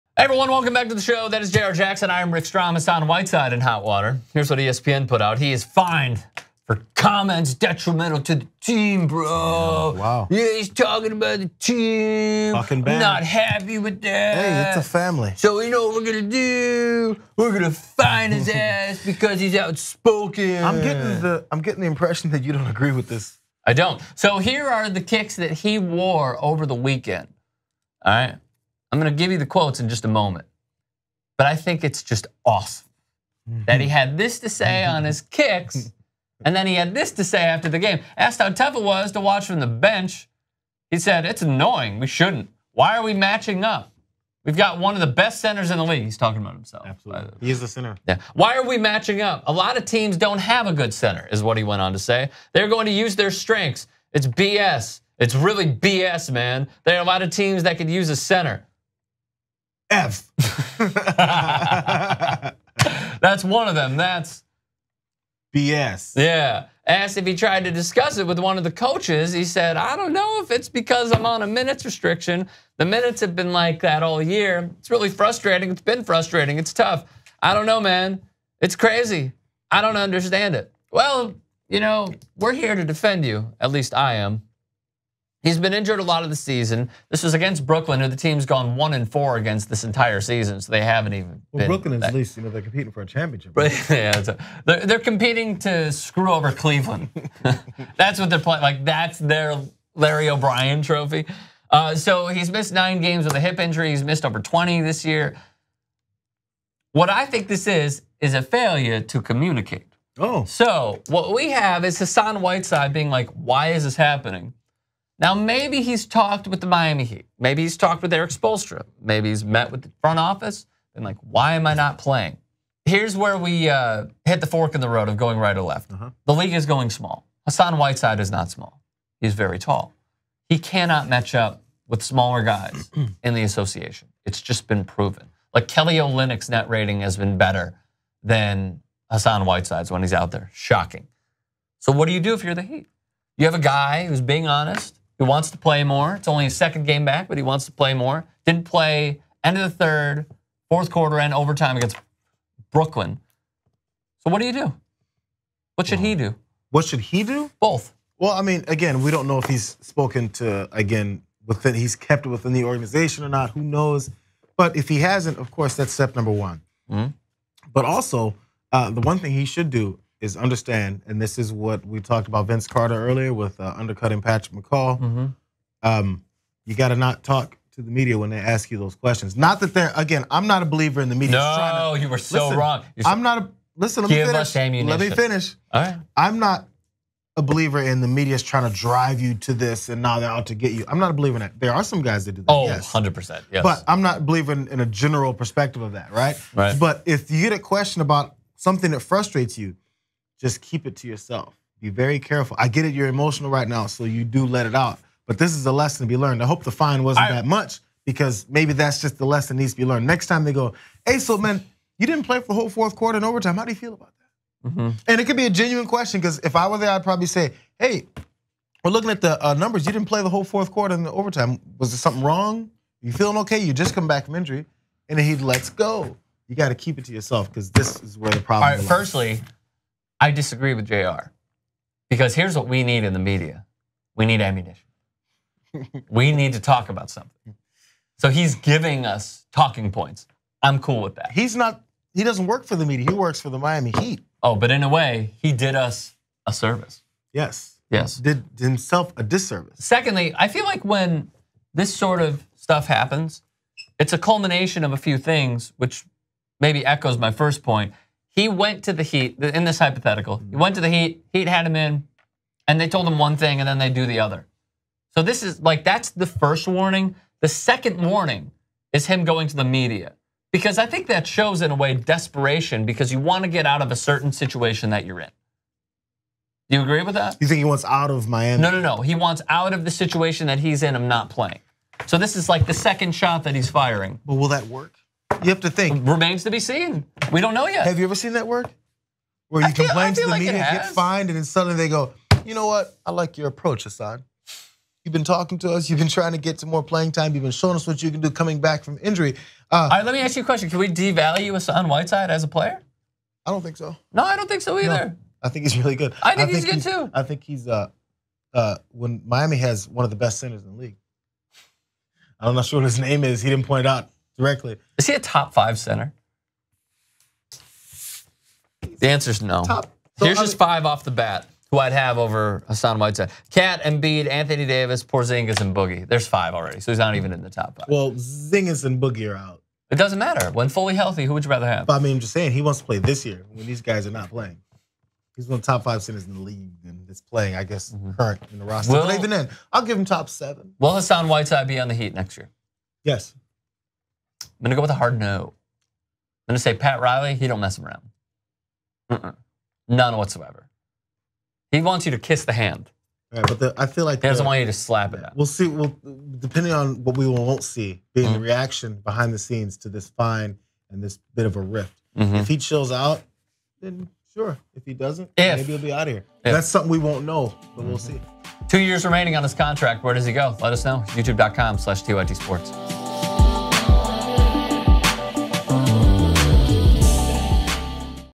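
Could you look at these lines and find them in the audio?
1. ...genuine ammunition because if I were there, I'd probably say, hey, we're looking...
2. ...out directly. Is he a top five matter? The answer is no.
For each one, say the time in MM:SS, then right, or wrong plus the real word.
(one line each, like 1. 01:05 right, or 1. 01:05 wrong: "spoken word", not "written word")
1. 03:35 wrong: "question", not "ammunition"
2. 05:13 wrong: "center", not "matter".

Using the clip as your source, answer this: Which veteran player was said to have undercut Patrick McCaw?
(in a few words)
Vince Carter.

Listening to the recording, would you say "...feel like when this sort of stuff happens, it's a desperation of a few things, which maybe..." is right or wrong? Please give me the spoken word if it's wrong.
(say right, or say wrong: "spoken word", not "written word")
wrong: "culmination", not "desperation".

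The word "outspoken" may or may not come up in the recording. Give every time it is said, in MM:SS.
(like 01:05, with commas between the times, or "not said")
00:19.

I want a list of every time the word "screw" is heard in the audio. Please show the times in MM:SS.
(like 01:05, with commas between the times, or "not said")
01:35.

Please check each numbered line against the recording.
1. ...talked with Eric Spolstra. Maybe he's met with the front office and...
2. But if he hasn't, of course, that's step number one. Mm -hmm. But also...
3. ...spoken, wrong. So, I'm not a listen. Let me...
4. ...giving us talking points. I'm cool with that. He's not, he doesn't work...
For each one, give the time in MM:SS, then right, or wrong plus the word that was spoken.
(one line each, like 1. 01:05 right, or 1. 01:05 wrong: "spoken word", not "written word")
1. 01:57 right
2. 02:44 right
3. 03:02 wrong: "listen", not "spoken"
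4. 03:58 right.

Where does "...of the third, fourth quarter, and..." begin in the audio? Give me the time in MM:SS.
02:29.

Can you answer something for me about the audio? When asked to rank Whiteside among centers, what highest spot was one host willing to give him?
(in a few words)
top seven.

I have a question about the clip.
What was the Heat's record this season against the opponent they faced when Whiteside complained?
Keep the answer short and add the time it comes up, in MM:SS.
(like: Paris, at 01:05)
1 and 4, at 01:28.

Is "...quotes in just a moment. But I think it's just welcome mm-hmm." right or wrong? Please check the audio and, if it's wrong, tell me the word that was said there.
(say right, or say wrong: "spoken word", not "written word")
wrong: "awesome", not "welcome".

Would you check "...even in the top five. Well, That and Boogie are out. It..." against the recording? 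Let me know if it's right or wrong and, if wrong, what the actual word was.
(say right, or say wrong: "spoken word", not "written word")
wrong: "Zingas", not "That".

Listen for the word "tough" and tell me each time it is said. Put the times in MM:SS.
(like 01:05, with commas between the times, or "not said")
00:38, 01:16.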